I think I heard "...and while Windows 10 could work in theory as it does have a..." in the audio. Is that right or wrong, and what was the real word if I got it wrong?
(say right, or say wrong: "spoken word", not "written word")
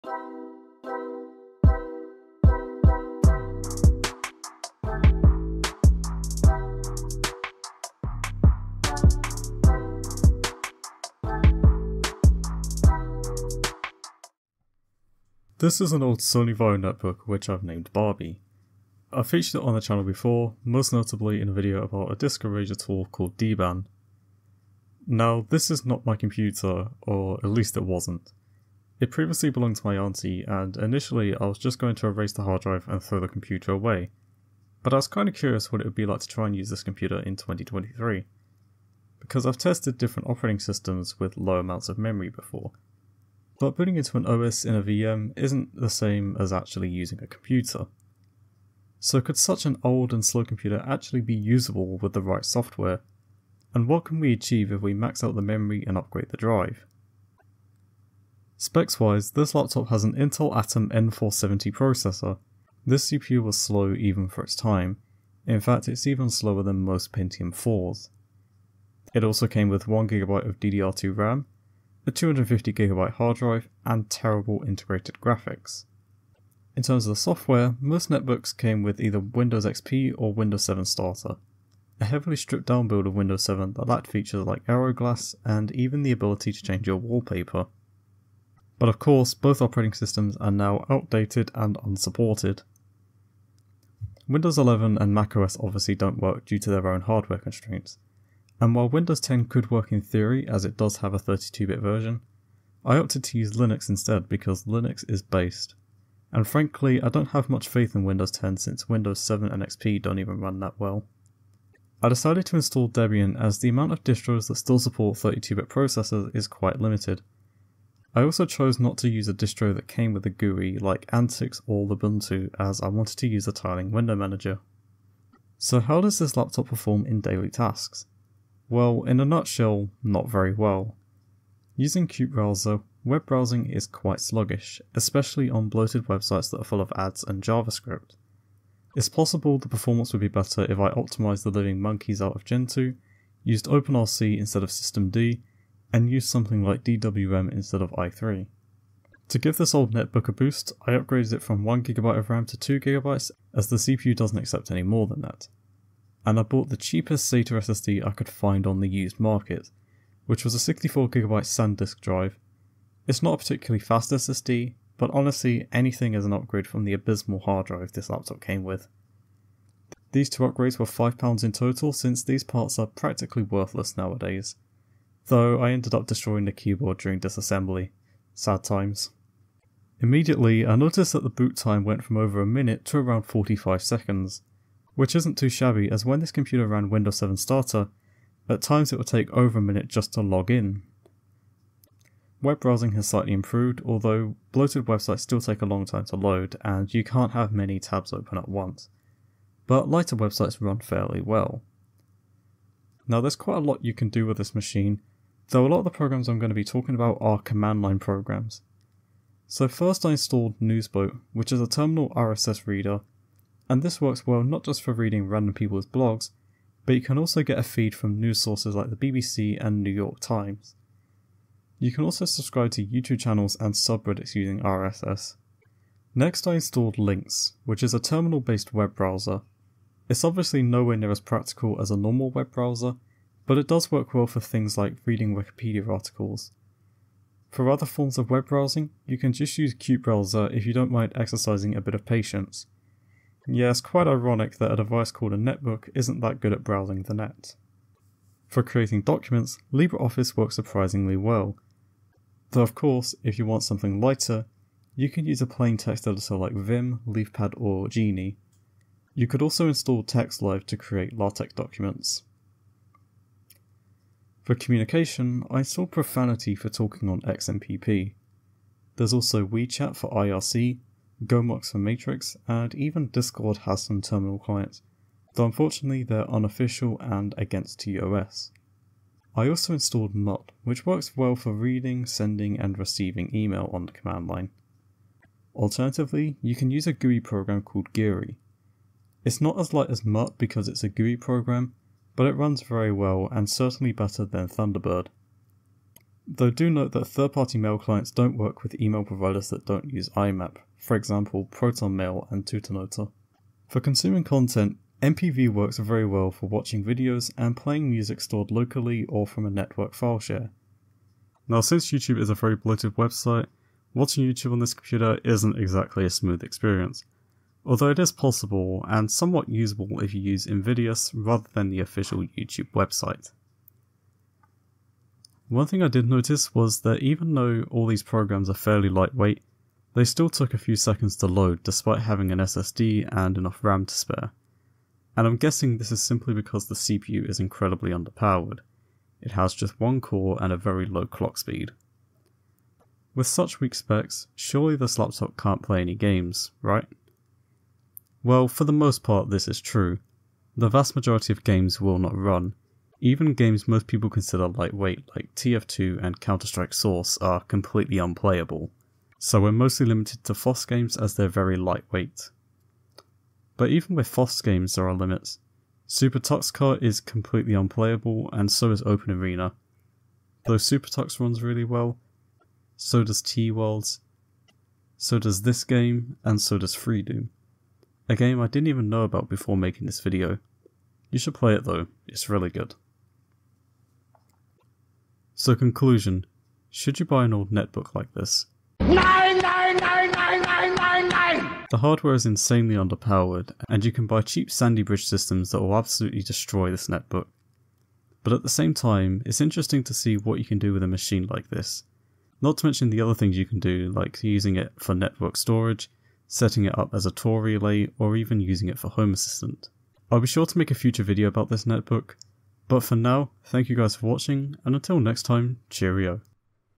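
right.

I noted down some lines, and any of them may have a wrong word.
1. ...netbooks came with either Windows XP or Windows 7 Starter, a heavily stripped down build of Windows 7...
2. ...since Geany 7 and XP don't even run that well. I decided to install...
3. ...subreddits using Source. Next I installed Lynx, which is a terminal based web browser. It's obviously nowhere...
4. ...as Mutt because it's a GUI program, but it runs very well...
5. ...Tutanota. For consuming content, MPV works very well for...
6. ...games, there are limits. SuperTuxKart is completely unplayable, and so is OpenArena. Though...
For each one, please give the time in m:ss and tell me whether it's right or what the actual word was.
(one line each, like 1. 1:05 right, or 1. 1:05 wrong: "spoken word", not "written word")
1. 1:18 right
2. 1:48 wrong: "Windows", not "Geany"
3. 3:43 wrong: "RSS", not "Source"
4. 4:49 right
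5. 5:02 right
6. 6:04 right.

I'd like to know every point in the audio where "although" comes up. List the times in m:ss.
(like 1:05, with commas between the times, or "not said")
3:13, 5:17.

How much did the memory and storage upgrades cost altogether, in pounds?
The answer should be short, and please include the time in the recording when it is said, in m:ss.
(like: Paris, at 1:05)
£5, at 2:50.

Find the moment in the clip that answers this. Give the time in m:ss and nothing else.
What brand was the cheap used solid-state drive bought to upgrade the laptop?
2:41.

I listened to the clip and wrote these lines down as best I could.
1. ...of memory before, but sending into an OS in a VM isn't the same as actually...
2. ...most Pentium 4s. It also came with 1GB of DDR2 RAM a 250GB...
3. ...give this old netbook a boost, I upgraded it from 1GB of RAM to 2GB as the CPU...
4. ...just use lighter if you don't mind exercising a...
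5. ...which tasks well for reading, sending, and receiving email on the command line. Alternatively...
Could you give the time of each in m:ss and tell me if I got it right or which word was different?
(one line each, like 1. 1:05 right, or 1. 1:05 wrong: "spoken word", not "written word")
1. 0:41 wrong: "booting", not "sending"
2. 1:06 right
3. 2:29 right
4. 3:59 wrong: "qutebrowser", not "lighter"
5. 4:40 wrong: "works", not "tasks".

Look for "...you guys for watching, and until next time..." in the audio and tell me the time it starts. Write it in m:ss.
6:53.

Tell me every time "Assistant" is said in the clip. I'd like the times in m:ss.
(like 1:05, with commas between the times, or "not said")
6:49.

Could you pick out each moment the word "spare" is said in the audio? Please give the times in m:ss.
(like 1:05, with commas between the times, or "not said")
5:33.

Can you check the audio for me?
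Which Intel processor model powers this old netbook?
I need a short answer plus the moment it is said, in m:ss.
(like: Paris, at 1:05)
Intel Atom N470, at 1:00.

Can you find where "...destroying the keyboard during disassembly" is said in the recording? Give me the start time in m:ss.
2:56.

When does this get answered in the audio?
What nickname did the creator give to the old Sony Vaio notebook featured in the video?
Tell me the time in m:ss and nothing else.
0:17.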